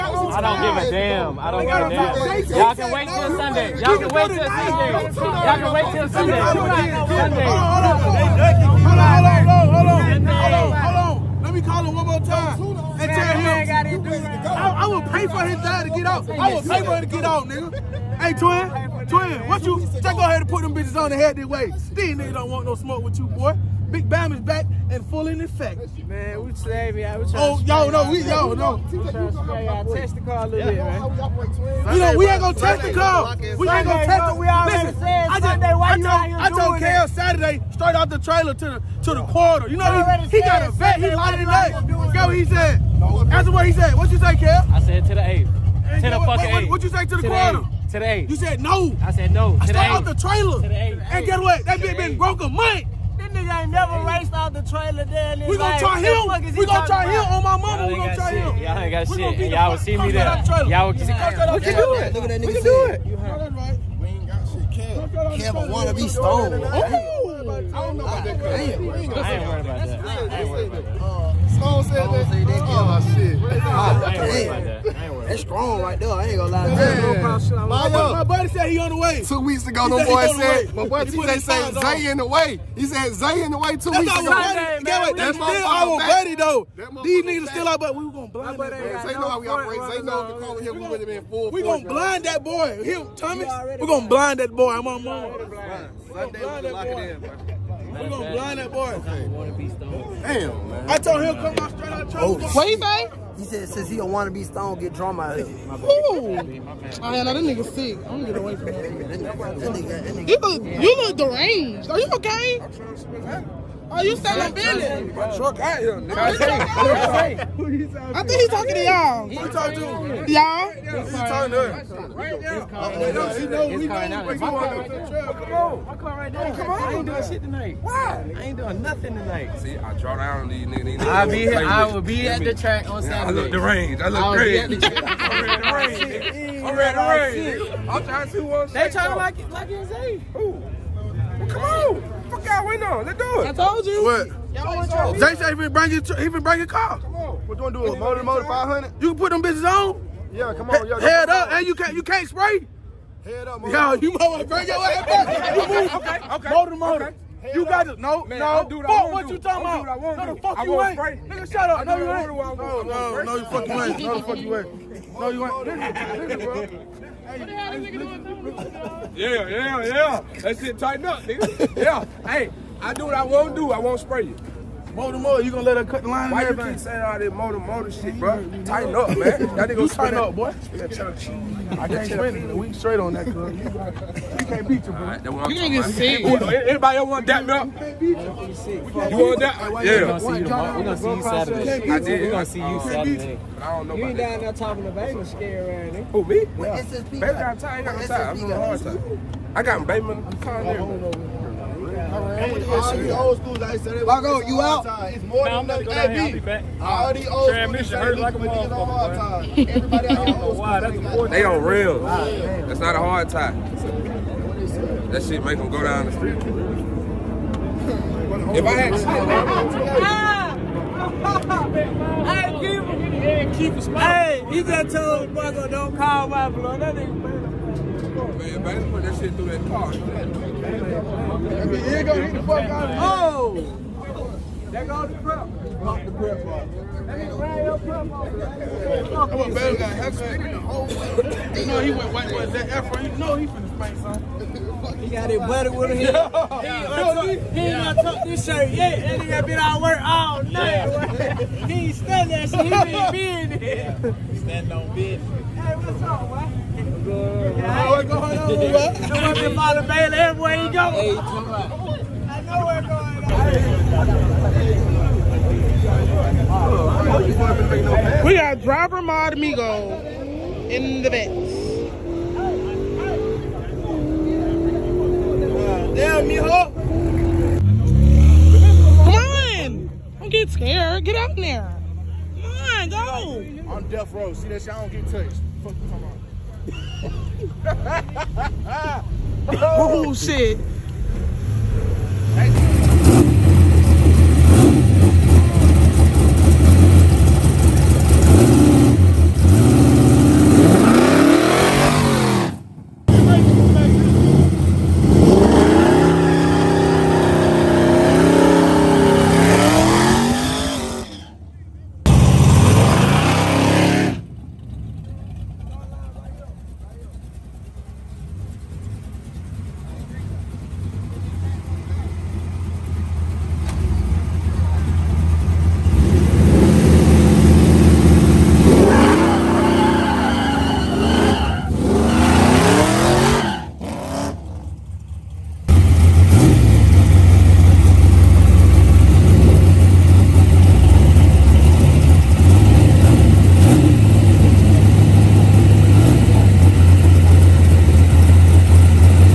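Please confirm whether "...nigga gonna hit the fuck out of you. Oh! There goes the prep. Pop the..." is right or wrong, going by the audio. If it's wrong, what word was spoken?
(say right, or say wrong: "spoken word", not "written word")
right.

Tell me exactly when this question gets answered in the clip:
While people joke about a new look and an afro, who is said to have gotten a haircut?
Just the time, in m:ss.
3:59.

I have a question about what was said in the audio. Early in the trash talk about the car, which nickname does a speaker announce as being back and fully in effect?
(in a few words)
Big Bam.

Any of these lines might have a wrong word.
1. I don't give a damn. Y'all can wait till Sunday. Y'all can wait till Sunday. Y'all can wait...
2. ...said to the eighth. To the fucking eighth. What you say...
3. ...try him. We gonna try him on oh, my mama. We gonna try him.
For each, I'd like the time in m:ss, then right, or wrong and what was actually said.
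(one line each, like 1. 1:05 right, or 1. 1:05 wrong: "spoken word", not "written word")
1. 0:01 right
2. 0:44 right
3. 0:55 right.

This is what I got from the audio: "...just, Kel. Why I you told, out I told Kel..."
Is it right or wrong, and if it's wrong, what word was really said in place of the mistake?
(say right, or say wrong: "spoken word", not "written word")
wrong: "Sunday", not "Kel".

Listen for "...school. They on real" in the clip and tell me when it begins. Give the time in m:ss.
3:31.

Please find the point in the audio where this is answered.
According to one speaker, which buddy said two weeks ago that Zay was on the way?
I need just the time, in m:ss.
1:21.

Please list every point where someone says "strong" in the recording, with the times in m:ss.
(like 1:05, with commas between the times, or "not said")
1:15.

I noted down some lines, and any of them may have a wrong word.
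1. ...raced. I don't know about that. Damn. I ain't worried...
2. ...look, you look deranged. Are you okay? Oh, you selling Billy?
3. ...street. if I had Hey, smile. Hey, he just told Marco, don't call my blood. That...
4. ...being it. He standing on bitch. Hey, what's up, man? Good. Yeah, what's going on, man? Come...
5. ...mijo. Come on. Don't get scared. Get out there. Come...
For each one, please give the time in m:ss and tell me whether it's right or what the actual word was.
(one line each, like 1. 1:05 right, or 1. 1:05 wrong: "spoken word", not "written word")
1. 1:06 wrong: "stoned", not "raced"
2. 1:50 right
3. 3:36 right
4. 4:13 right
5. 4:36 right.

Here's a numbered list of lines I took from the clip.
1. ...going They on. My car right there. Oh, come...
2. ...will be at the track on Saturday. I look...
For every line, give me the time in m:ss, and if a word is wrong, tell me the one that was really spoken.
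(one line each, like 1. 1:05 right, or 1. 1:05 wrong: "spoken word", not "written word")
1. 2:04 wrong: "Come", not "They"
2. 2:11 right.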